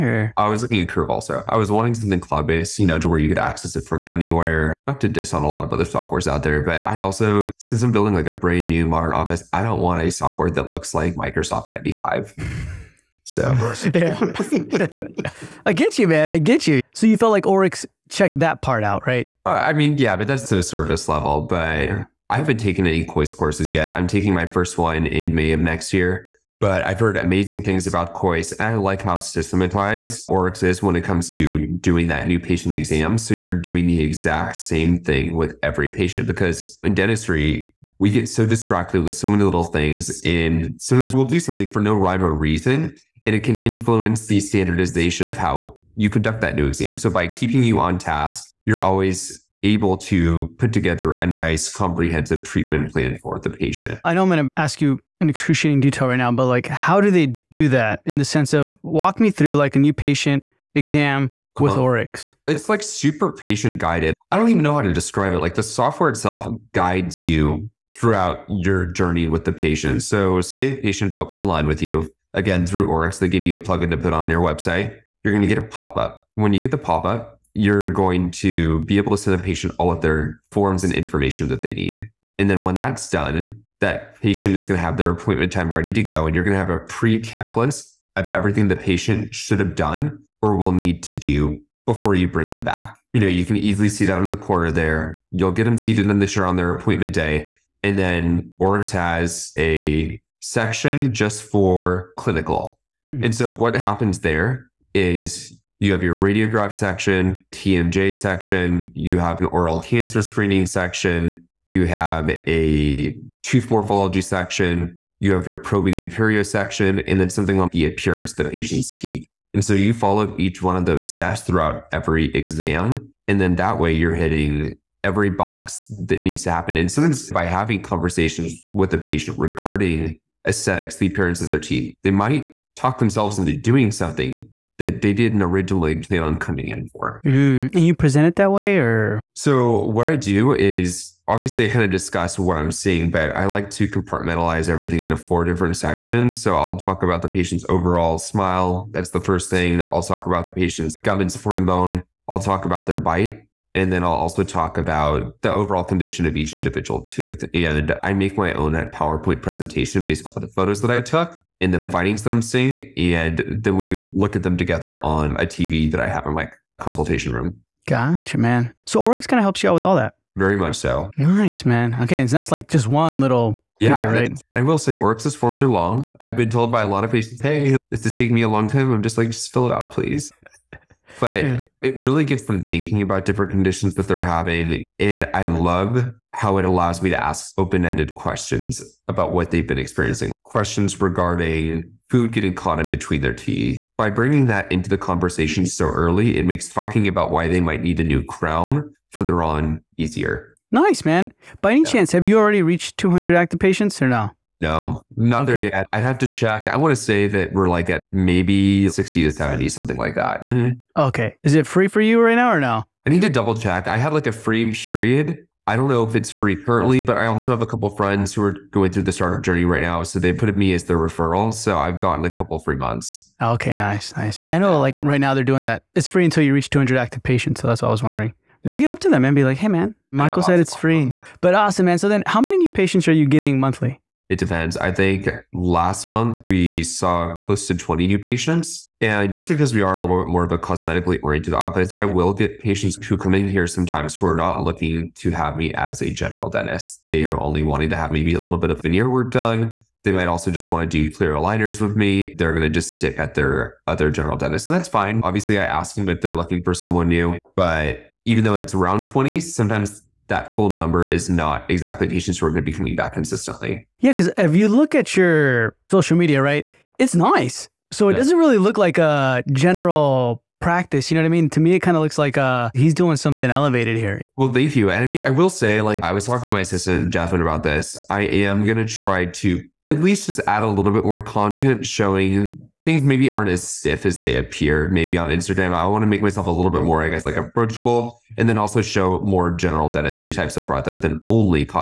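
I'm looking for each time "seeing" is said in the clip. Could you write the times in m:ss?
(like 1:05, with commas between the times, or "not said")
2:22, 2:42.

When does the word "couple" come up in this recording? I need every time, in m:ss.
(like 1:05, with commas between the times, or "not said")
3:37, 3:42.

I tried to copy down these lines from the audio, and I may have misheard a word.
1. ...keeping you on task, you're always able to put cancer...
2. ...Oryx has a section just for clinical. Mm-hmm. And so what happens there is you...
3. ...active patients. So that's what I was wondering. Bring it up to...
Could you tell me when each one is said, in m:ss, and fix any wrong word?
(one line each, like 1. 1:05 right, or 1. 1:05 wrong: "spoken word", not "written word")
1. 0:47 wrong: "together", not "cancer"
2. 1:38 right
3. 3:46 right.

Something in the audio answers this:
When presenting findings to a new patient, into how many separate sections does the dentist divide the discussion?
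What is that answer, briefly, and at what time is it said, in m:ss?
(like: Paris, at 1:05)
4, at 2:25.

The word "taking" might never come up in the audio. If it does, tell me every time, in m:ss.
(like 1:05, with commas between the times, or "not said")
0:24, 2:58.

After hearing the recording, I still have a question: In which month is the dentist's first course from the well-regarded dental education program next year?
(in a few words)
May.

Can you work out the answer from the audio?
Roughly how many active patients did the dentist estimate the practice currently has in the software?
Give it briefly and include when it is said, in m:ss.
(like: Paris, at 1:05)
60 to 70, at 3:28.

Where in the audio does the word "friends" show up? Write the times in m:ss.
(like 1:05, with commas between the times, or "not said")
3:37.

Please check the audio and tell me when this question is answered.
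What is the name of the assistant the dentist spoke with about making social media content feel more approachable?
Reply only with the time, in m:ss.
4:37.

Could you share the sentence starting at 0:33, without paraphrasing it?
So you're doing the exact same thing with every patient because in dentistry, we get so distracted with so many little things.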